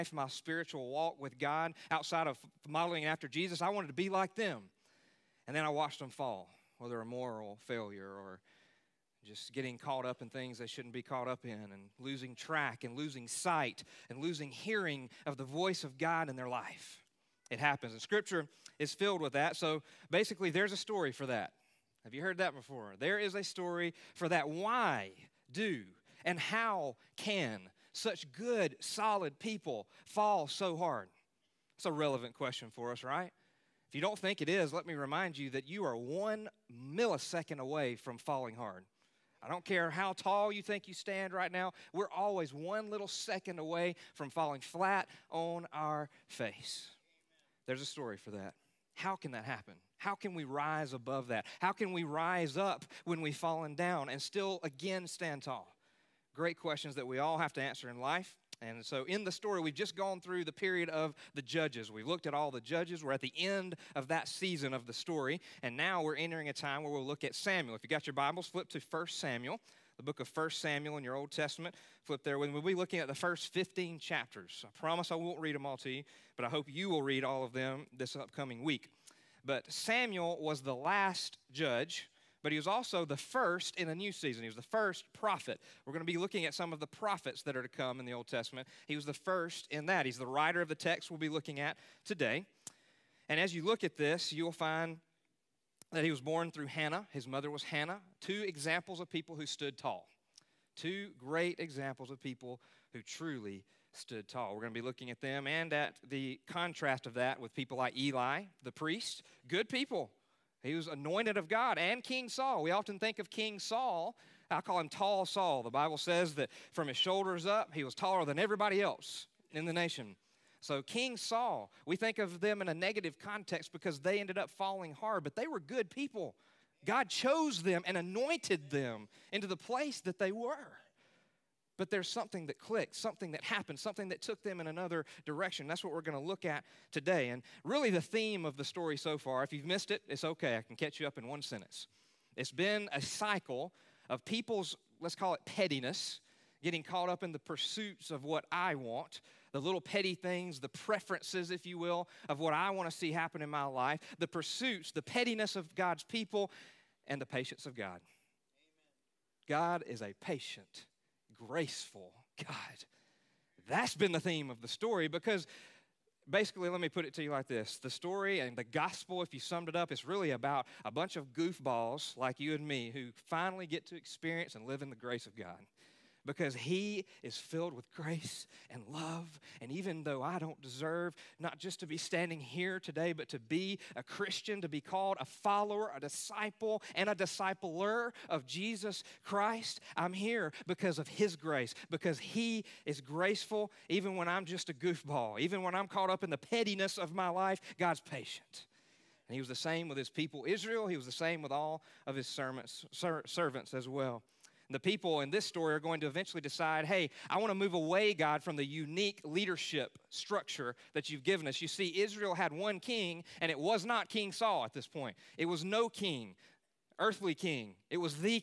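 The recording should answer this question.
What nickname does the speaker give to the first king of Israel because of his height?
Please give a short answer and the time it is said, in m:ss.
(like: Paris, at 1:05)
Tall Saul, at 1:54.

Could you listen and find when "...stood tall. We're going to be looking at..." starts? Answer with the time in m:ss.
1:43.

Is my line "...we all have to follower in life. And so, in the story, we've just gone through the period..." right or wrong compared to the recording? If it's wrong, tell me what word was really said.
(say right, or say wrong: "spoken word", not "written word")
wrong: "answer", not "follower".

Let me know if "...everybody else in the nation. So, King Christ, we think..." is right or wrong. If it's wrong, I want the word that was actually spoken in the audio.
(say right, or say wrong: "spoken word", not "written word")
wrong: "Saul", not "Christ".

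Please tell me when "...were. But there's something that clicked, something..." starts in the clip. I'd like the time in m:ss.
2:10.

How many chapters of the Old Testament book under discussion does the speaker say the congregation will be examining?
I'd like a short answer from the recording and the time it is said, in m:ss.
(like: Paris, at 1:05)
15, at 1:13.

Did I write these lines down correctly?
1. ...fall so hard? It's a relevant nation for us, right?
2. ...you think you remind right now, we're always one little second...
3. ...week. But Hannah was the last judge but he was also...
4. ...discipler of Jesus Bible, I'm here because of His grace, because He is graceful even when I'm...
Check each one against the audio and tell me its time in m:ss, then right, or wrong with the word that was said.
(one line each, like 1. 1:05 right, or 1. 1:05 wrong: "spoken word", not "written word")
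1. 0:30 wrong: "question", not "nation"
2. 0:40 wrong: "stand", not "remind"
3. 1:18 wrong: "Samuel", not "Hannah"
4. 3:07 wrong: "Christ", not "Bible".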